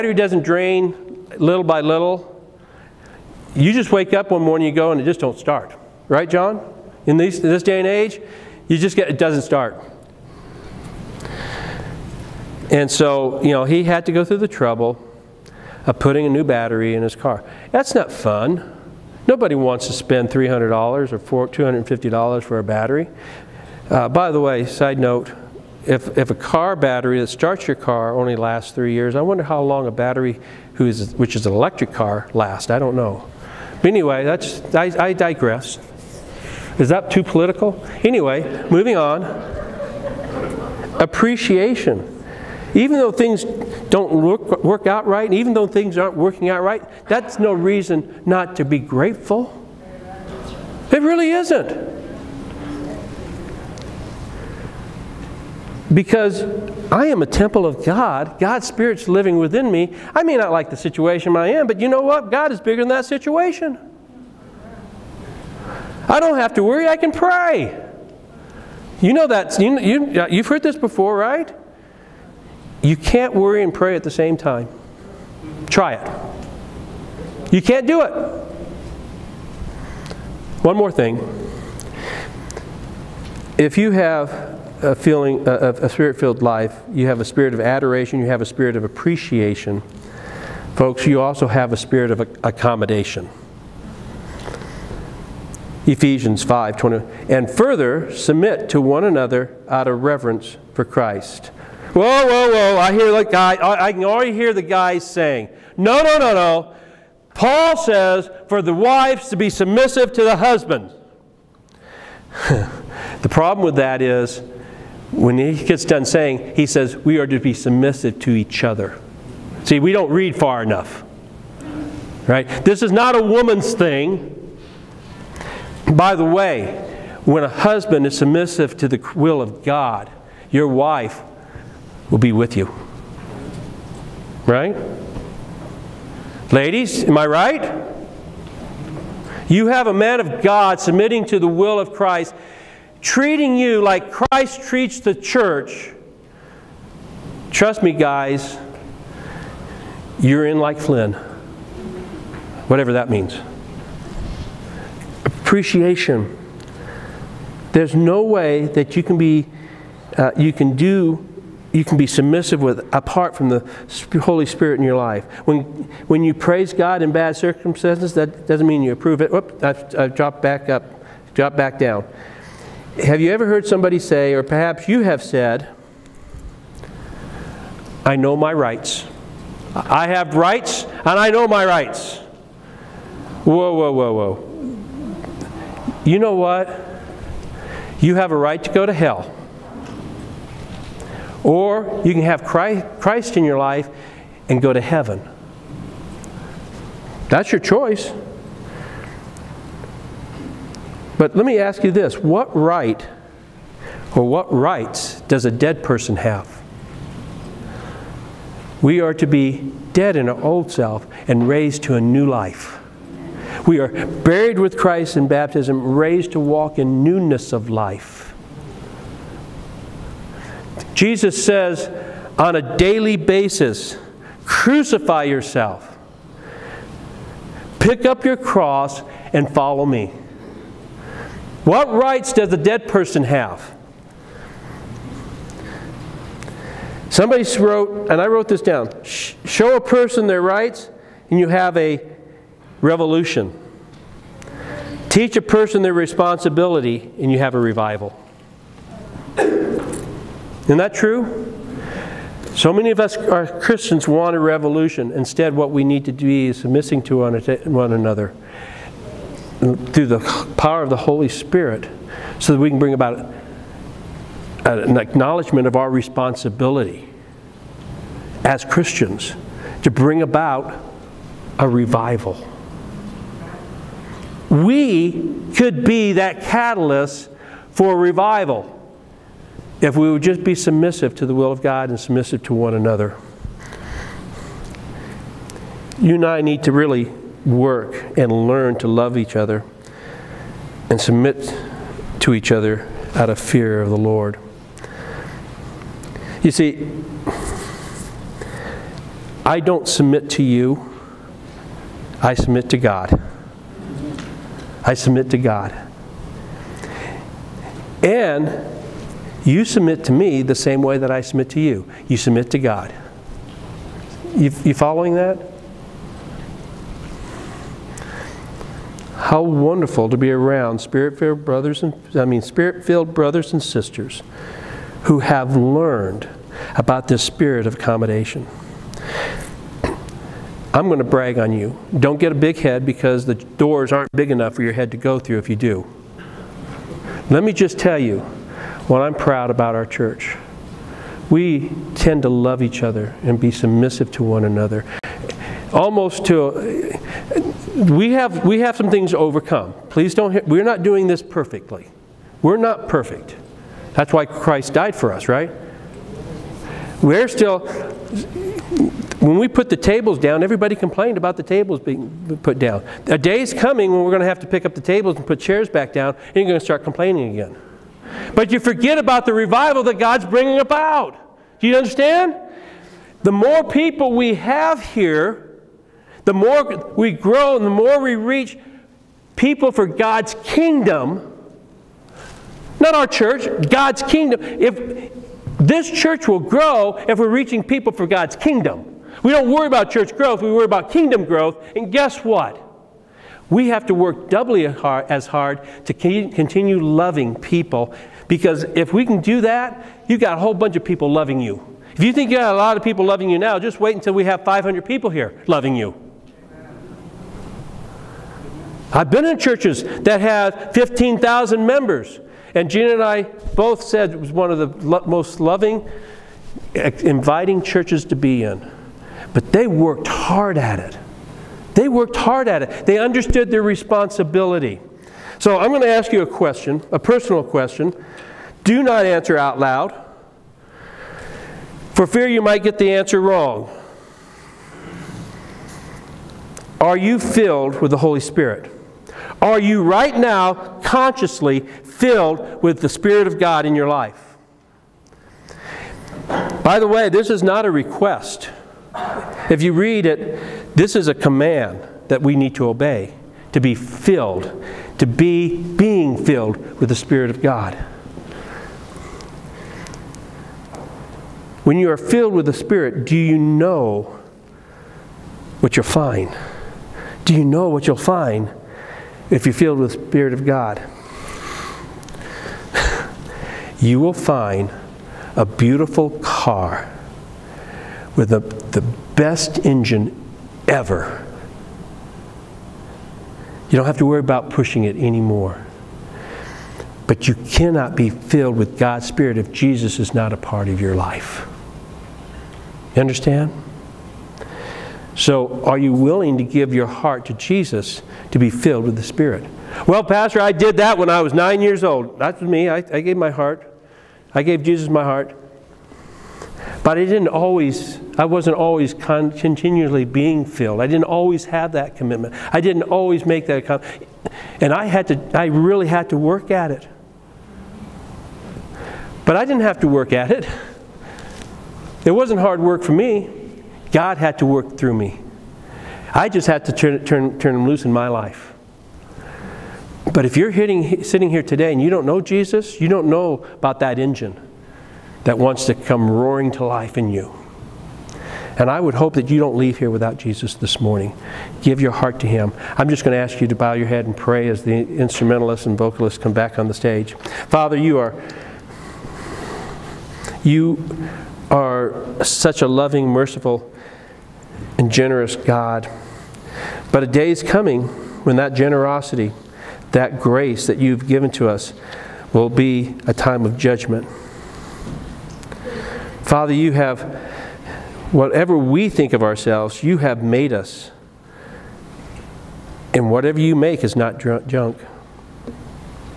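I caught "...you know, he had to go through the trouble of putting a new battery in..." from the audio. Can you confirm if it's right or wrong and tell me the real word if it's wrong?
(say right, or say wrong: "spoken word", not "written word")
right.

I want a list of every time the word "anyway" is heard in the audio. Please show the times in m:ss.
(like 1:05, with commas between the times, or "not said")
0:33, 0:38.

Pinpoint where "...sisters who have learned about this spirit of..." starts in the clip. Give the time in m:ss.
5:23.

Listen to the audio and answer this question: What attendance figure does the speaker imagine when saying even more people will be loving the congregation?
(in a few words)
500.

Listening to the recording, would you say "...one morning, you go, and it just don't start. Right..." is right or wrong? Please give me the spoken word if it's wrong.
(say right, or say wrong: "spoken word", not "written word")
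right.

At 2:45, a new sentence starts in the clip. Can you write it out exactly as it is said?
When, when you praise God in bad circumstances, that doesn't mean you approve it.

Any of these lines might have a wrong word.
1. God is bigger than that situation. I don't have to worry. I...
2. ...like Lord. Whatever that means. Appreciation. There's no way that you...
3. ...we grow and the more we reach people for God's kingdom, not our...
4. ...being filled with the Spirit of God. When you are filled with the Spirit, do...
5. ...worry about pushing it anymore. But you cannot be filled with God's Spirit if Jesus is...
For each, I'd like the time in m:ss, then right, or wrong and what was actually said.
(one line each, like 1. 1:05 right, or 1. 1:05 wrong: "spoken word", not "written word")
1. 1:02 right
2. 2:30 wrong: "Flynn", not "Lord"
3. 6:16 right
4. 7:35 right
5. 8:04 right.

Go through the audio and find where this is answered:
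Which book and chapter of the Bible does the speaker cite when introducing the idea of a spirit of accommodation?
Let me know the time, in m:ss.
1:35.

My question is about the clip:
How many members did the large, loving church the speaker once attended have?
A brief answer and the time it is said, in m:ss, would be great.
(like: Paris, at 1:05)
15,000, at 6:50.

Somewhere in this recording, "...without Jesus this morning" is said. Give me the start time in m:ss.
8:59.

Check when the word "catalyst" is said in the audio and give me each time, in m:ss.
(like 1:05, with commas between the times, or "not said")
4:36.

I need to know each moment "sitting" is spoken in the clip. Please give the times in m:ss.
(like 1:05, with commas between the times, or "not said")
8:51.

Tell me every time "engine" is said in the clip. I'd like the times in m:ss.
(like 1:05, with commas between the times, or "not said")
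7:59, 8:53.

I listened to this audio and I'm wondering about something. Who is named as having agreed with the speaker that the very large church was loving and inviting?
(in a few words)
Gina.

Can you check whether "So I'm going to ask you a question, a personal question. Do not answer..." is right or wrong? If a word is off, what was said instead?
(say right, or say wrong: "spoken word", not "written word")
right.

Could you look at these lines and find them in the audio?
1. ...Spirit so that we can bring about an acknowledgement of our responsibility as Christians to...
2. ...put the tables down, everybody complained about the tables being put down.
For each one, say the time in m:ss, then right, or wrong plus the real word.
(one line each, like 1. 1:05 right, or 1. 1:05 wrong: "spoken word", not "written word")
1. 4:21 right
2. 5:59 right.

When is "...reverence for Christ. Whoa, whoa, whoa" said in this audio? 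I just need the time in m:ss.
1:40.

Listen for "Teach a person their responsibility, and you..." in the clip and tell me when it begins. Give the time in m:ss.
4:05.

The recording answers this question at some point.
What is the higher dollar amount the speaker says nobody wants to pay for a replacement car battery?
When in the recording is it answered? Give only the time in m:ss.
0:20.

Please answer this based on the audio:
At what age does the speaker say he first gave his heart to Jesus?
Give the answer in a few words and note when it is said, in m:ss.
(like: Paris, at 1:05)
9, at 8:21.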